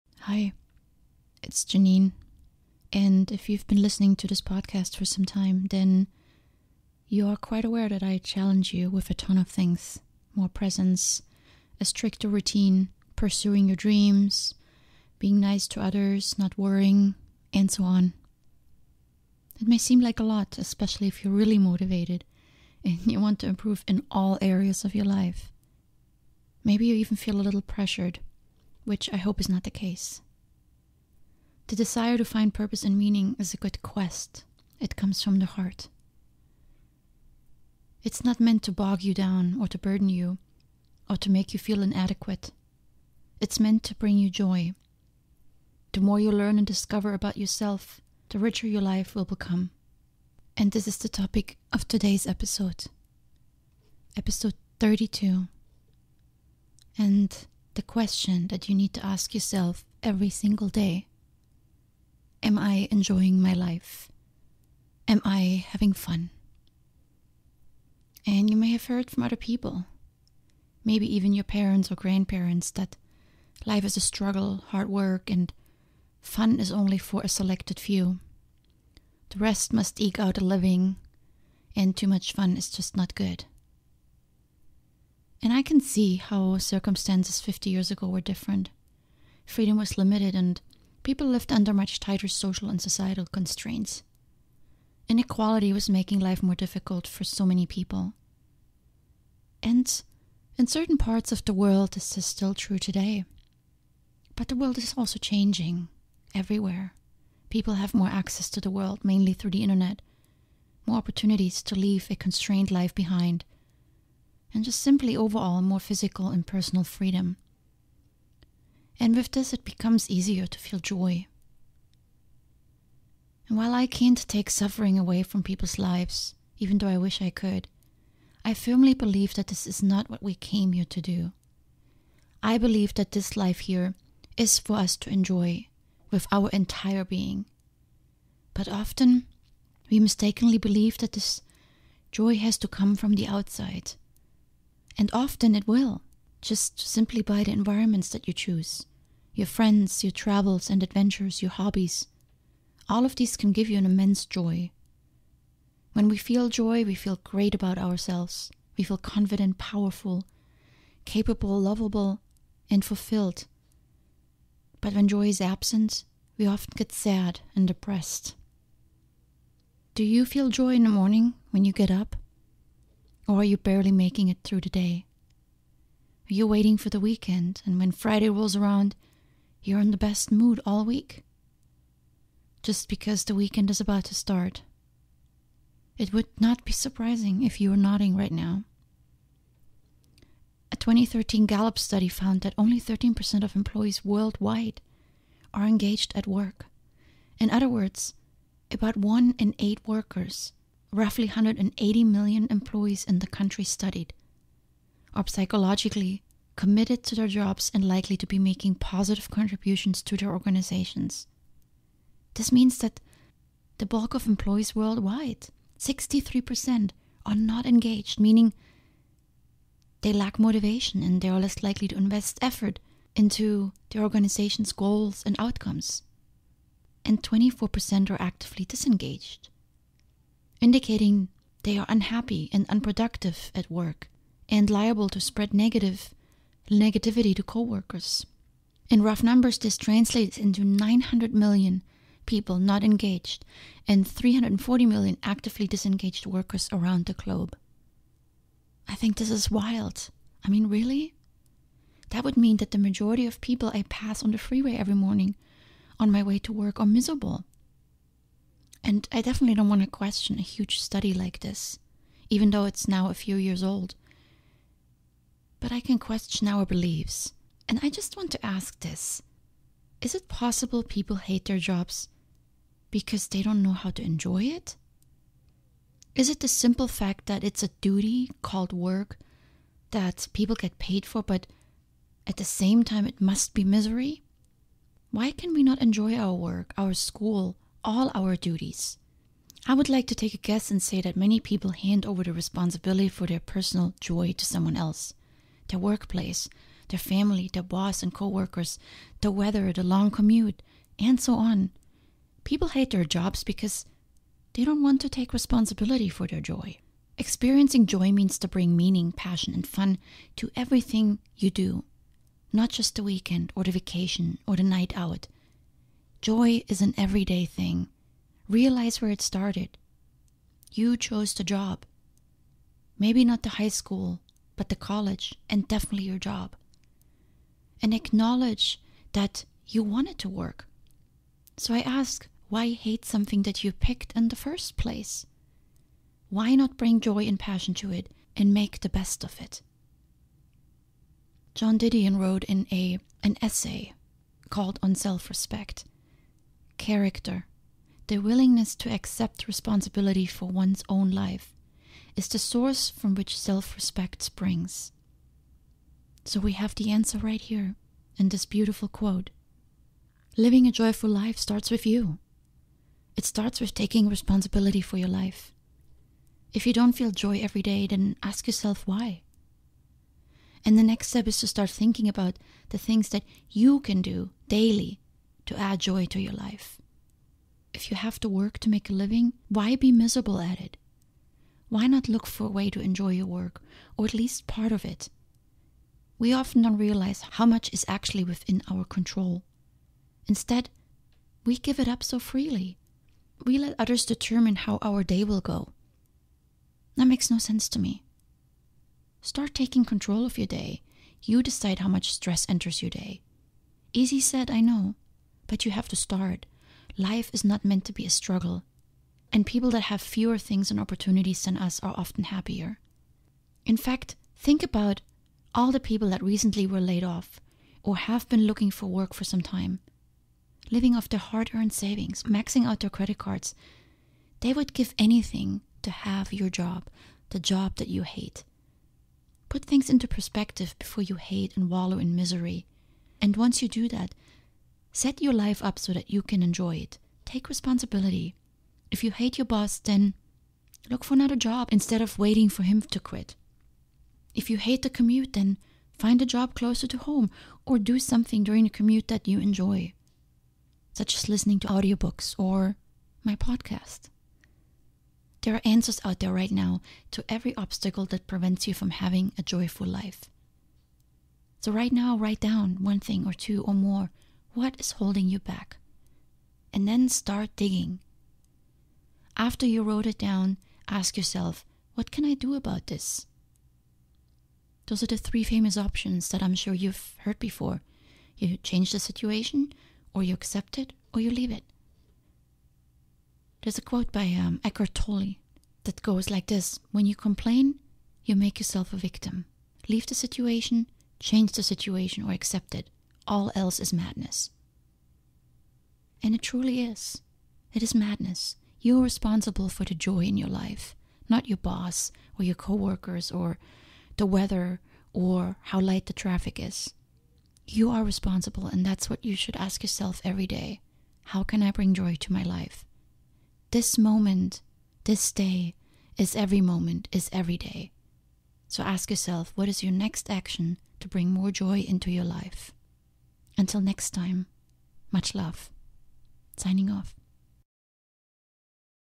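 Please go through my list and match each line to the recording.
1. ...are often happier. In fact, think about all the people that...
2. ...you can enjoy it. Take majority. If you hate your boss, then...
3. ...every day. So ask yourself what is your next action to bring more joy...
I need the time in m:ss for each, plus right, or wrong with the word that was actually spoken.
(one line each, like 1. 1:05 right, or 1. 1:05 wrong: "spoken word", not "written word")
1. 6:51 right
2. 7:16 wrong: "responsibility", not "majority"
3. 8:37 right.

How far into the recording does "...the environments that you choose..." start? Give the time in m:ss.
2:27.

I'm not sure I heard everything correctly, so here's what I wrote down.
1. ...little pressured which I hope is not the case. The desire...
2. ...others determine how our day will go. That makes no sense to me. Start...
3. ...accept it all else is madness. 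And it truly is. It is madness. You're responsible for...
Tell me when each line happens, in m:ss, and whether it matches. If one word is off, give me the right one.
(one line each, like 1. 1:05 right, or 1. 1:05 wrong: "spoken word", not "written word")
1. 0:27 right
2. 6:33 right
3. 8:12 right.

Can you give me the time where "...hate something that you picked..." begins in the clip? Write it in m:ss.
5:32.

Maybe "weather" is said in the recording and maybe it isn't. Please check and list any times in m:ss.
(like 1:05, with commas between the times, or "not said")
4:59, 8:24.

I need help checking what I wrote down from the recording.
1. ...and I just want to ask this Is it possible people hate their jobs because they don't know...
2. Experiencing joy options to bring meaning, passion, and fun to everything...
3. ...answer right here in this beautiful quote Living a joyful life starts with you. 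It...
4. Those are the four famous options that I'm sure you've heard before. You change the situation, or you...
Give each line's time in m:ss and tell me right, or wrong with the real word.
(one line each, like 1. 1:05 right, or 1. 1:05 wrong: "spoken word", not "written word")
1. 4:27 right
2. 5:07 wrong: "means", not "options"
3. 5:56 right
4. 7:54 wrong: "three", not "four".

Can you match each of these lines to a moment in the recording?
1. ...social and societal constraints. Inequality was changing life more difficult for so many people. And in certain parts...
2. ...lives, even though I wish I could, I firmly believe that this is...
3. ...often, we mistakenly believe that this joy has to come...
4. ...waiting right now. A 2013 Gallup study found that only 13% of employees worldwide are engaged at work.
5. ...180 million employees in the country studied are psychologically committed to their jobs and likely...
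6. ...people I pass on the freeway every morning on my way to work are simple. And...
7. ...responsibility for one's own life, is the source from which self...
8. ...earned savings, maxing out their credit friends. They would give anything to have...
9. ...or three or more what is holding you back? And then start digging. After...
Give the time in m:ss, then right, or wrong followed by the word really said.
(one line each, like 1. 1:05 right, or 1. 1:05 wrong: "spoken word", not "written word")
1. 1:32 wrong: "making", not "changing"
2. 2:05 right
3. 2:18 right
4. 3:07 wrong: "nodding", not "waiting"
5. 3:21 right
6. 4:13 wrong: "miserable", not "simple"
7. 5:49 right
8. 7:01 wrong: "cards", not "friends"
9. 7:43 wrong: "two", not "three".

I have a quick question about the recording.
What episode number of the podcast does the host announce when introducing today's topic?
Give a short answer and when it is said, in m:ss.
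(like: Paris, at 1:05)
32, at 0:54.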